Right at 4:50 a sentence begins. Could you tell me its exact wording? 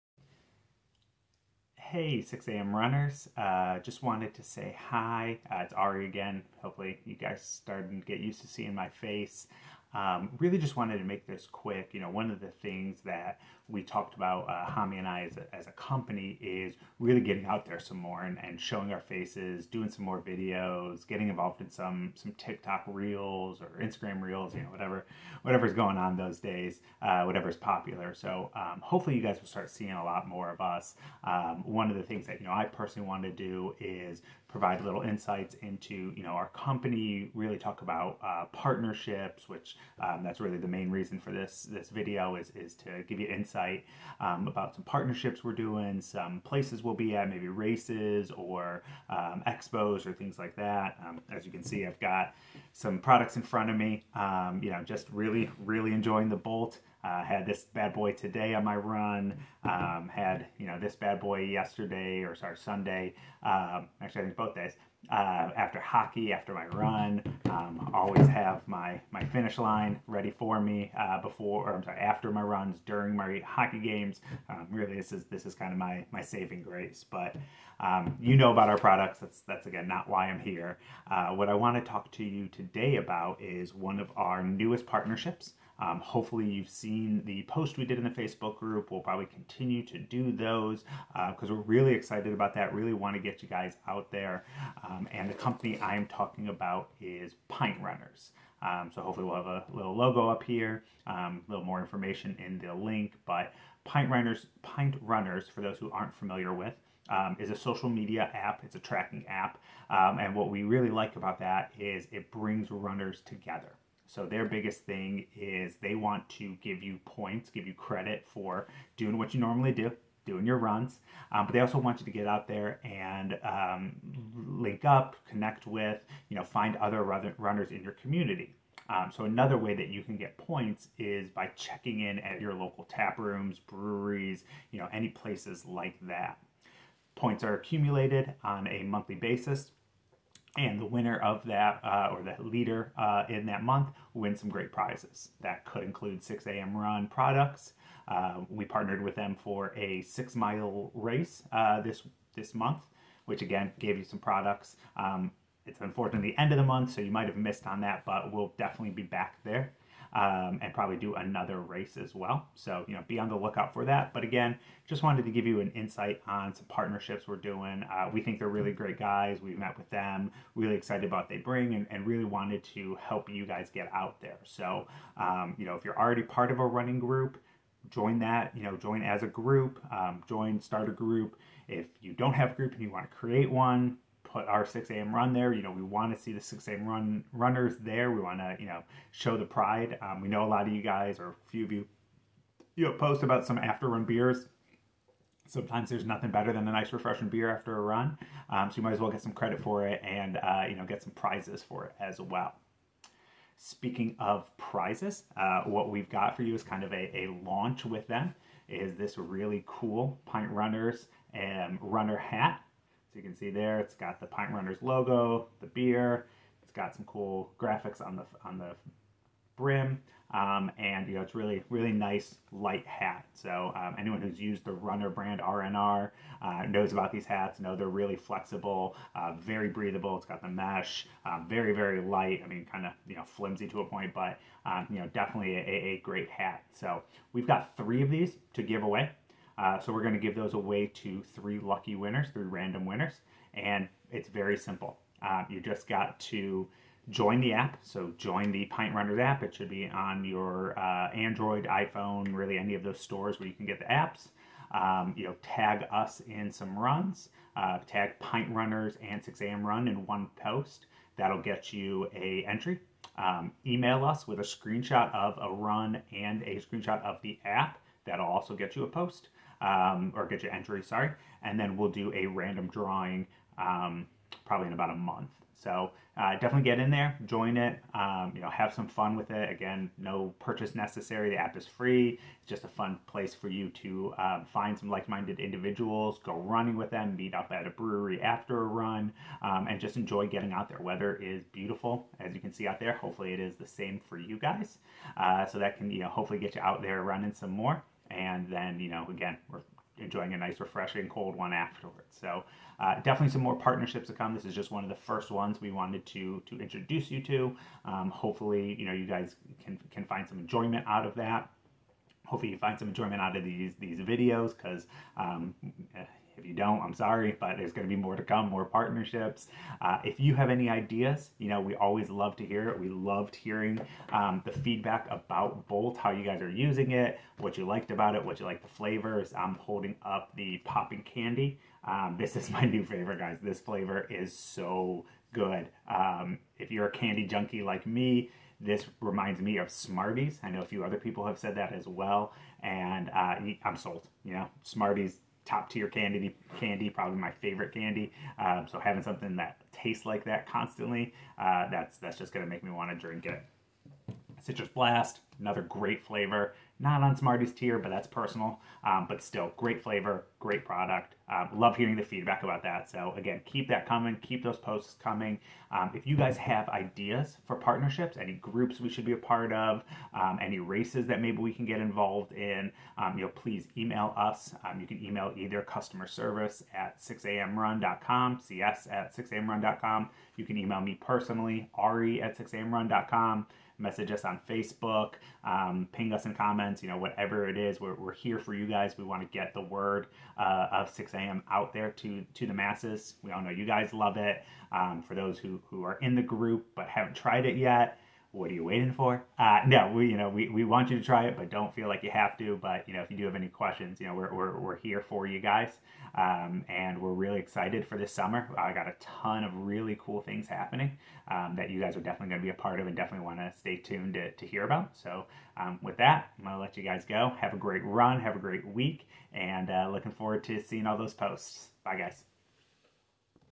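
Weather is beautiful, as you can see out there.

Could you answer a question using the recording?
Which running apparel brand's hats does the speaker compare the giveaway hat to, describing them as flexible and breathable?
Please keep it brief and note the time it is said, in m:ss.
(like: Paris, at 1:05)
RNR, at 3:44.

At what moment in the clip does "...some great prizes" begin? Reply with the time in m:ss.
2:24.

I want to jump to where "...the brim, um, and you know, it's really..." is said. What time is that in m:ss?
3:38.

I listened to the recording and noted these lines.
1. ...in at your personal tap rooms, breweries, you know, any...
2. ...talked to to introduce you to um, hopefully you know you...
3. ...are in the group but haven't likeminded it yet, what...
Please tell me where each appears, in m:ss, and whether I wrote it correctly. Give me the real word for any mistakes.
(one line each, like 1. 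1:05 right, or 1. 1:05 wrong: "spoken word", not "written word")
1. 2:12 wrong: "local", not "personal"
2. 5:05 wrong: "wanted", not "talked"
3. 6:35 wrong: "tried", not "likeminded".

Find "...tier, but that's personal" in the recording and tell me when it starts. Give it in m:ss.
5:57.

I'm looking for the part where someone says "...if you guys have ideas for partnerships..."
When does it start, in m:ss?
6:05.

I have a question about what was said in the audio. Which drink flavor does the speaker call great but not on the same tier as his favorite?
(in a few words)
Citrus Blast.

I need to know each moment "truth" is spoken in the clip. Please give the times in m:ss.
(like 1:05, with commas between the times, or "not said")
not said.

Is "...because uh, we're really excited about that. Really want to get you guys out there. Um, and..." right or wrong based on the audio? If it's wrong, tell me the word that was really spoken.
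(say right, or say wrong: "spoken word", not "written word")
right.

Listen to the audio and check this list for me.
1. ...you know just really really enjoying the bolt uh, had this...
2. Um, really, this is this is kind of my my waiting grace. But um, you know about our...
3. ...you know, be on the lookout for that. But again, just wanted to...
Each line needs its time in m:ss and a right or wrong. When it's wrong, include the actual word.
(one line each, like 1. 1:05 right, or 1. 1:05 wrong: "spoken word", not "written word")
1. 0:54 right
2. 1:14 wrong: "saving", not "waiting"
3. 2:42 right.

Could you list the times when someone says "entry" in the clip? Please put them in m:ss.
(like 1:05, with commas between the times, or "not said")
4:22, 4:30.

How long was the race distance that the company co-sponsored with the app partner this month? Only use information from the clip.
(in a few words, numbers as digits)
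6 miles.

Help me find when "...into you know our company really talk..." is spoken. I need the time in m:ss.
0:35.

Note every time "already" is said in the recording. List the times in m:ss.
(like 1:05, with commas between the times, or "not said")
2:55.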